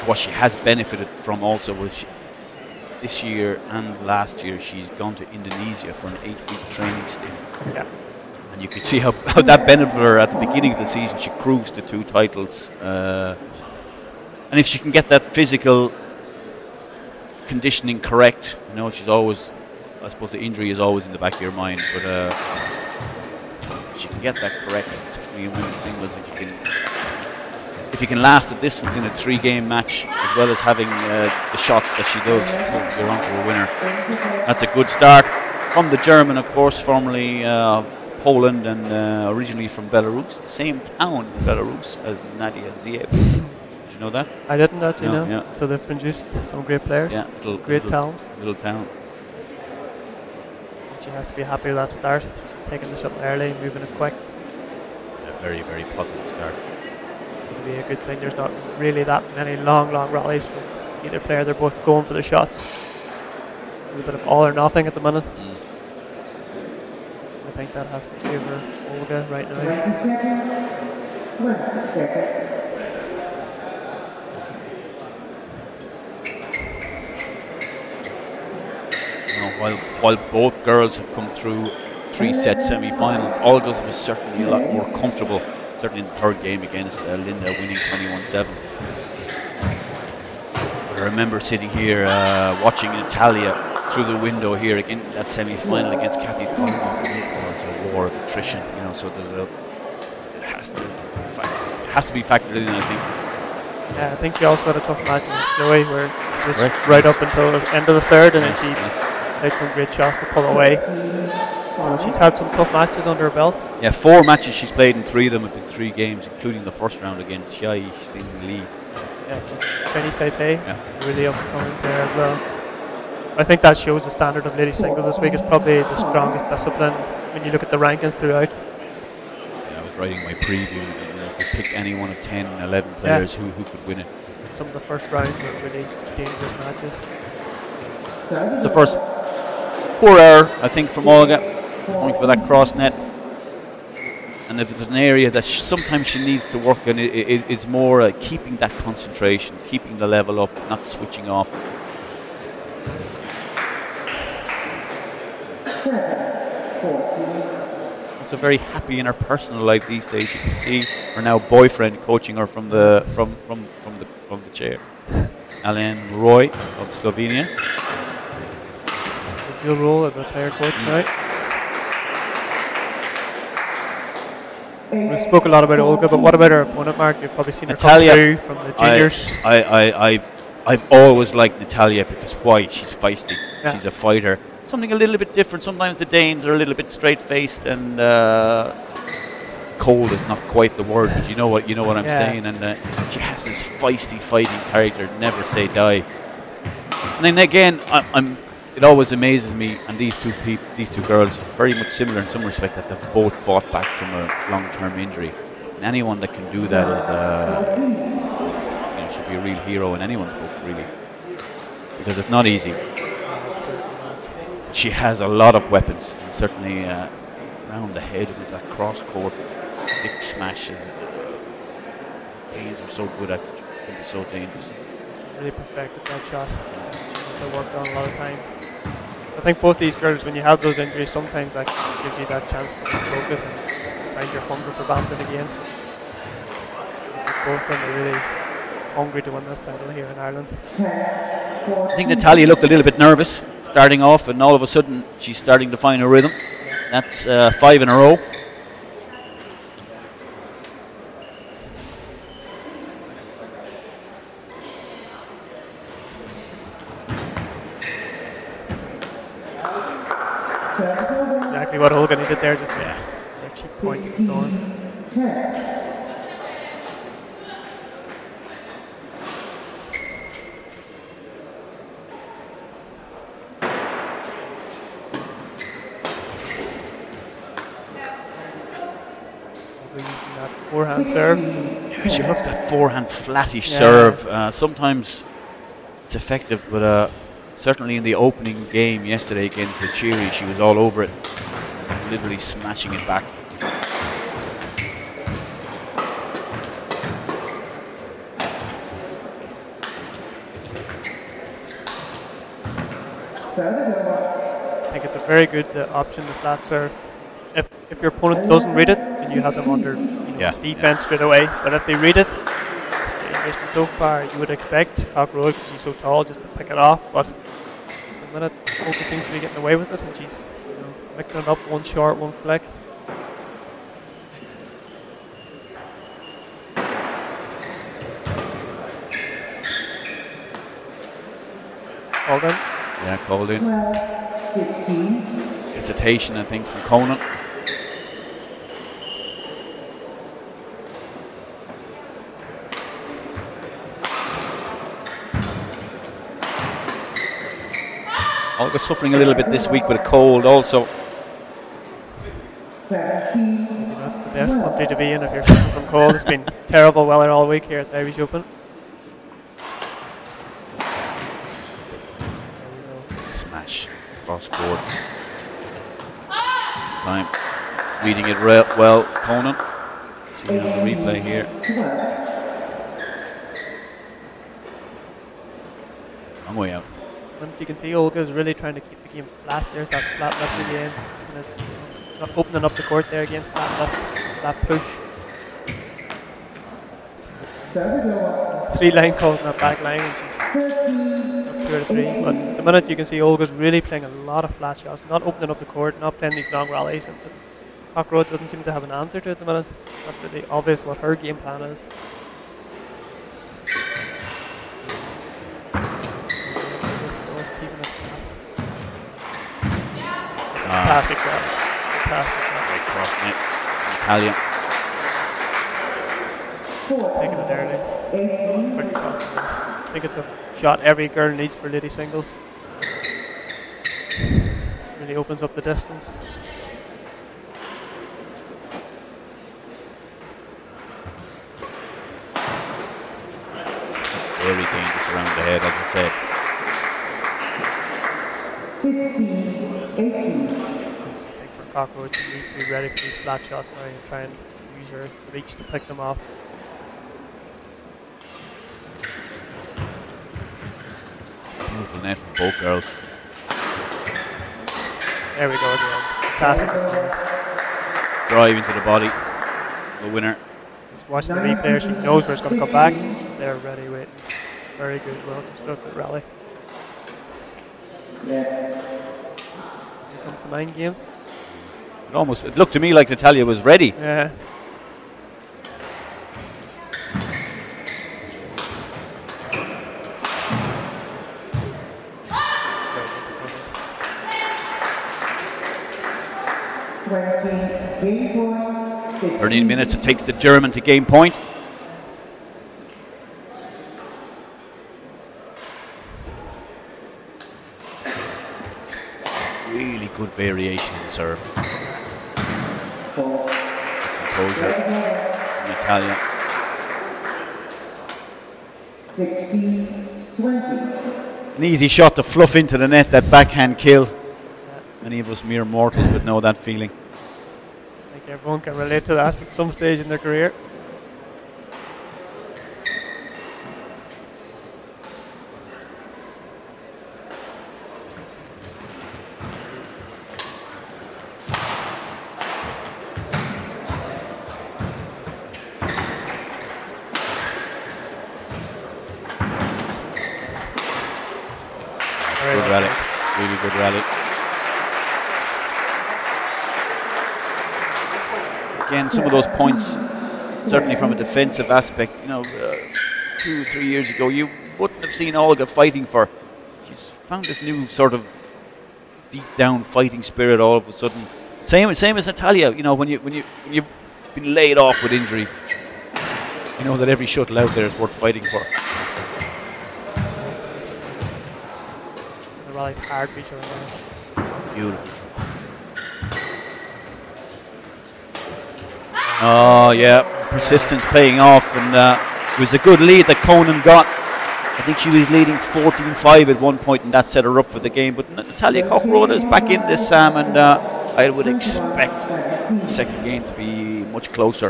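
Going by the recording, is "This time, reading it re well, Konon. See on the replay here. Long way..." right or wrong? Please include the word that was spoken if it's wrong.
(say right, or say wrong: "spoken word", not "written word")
right.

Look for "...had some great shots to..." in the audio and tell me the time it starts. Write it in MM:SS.
01:49.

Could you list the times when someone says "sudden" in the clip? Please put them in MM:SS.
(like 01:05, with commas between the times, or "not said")
04:04, 09:20.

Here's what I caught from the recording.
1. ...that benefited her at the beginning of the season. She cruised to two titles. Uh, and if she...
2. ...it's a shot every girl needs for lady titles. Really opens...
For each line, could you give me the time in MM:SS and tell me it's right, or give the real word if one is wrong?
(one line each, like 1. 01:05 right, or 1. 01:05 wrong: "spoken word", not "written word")
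1. 00:09 right
2. 07:00 wrong: "singles", not "titles".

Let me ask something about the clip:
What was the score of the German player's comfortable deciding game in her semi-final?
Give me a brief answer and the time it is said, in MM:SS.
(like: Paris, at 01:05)
21-7, at 01:27.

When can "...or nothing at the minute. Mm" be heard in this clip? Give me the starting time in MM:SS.
01:04.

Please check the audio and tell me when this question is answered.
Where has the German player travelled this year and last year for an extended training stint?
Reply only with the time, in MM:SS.
00:05.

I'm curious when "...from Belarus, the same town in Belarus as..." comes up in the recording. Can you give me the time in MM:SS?
00:39.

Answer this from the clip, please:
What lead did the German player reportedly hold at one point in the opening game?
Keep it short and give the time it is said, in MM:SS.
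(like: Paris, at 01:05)
14-5, at 09:45.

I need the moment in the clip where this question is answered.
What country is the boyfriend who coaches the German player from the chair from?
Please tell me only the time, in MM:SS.
02:46.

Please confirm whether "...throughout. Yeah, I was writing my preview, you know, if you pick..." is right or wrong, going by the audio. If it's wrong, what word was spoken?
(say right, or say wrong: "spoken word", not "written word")
right.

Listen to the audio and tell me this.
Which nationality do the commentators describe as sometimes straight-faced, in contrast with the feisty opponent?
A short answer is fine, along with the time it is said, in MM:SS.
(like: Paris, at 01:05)
Danes, at 03:06.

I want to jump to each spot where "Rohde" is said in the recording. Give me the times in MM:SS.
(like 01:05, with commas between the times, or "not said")
05:15, 06:38, 09:49.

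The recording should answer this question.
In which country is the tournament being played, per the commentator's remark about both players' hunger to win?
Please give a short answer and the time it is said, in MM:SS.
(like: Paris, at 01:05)
Ireland, at 04:00.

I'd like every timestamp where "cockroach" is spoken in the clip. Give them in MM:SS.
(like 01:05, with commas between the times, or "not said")
07:21.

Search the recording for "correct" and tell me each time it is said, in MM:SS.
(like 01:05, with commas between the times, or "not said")
00:17, 00:24.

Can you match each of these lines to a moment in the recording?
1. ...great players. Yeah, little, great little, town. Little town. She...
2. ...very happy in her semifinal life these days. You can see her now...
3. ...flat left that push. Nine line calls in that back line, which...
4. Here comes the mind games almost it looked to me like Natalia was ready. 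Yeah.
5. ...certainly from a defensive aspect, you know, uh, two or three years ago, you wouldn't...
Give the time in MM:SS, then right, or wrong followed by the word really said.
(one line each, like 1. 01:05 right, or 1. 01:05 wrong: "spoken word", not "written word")
1. 00:46 right
2. 02:38 wrong: "personal", not "semifinal"
3. 06:23 wrong: "Three", not "Nine"
4. 07:49 right
5. 09:10 right.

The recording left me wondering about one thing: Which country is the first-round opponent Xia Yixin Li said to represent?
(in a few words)
Chinese Taipei.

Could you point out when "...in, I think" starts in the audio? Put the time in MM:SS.
01:42.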